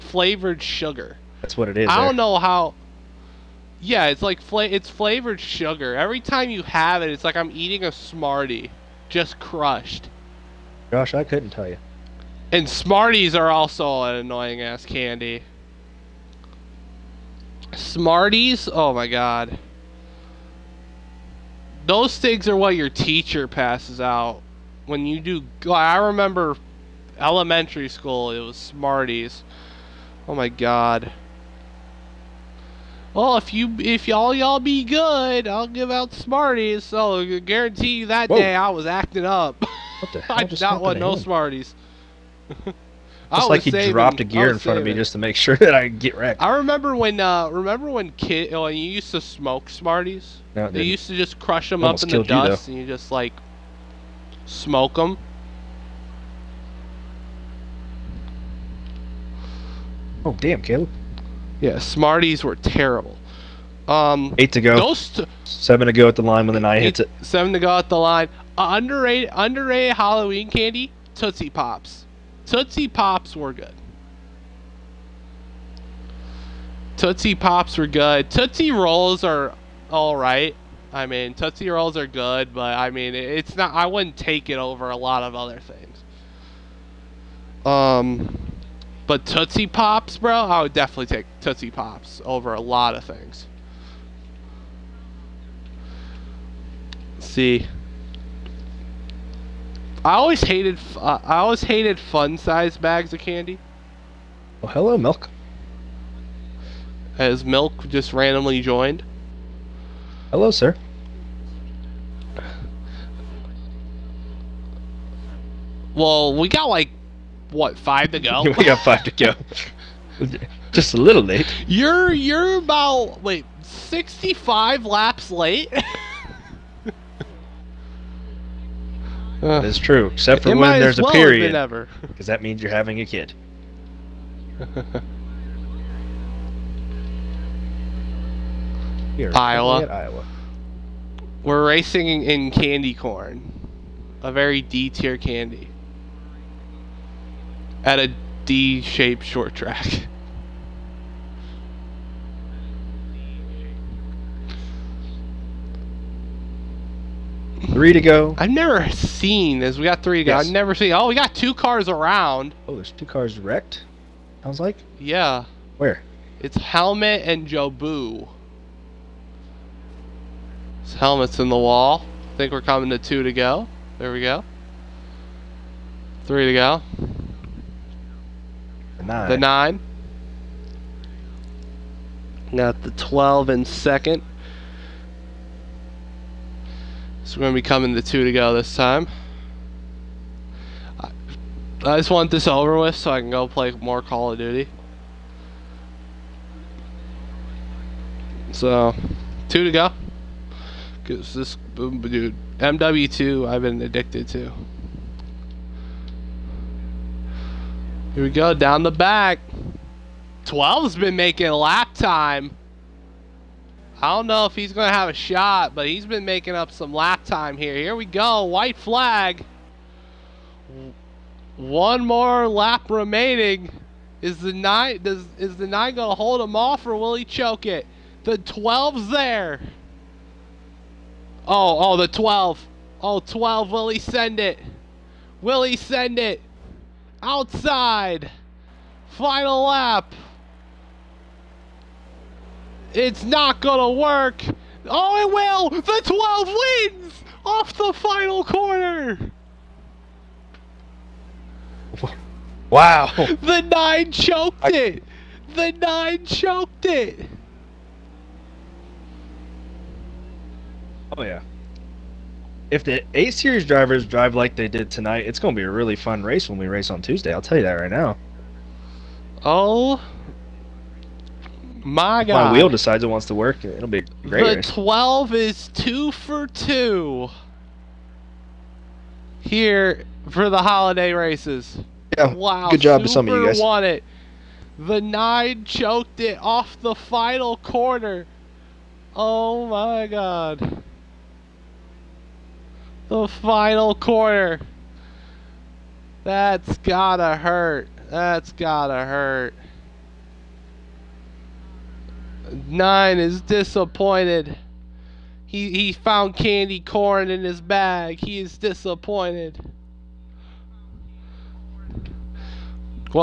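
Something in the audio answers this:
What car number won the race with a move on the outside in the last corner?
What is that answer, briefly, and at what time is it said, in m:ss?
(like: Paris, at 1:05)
12, at 4:06.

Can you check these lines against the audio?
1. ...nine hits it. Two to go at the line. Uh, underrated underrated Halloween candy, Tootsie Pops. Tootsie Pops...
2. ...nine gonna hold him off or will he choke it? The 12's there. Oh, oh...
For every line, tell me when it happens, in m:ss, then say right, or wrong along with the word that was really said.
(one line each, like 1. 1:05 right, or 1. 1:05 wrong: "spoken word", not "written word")
1. 1:06 wrong: "Seven", not "Two"
2. 3:45 right.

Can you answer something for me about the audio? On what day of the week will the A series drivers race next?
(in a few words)
Tuesday.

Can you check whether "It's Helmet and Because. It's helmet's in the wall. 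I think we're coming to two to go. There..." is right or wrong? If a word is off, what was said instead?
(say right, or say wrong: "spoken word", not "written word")
wrong: "Jobu", not "Because".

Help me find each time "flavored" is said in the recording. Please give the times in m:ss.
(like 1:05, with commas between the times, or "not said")
0:00, 0:04.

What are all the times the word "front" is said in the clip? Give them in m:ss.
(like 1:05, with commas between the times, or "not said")
0:44.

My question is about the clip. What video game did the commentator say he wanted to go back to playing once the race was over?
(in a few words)
MW2.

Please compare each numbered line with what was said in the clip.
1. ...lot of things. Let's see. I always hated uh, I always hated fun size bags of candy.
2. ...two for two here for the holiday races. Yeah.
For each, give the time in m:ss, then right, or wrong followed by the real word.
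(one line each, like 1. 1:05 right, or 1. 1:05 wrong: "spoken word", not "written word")
1. 1:32 right
2. 4:35 right.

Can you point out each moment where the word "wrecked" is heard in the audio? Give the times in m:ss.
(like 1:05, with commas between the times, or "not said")
0:46, 2:43.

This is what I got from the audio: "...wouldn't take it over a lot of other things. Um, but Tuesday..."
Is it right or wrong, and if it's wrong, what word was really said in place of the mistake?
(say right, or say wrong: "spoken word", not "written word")
wrong: "Tootsie", not "Tuesday".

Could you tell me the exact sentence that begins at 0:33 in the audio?
Well, if you if y'all y'all be good, I'll give out Smarties.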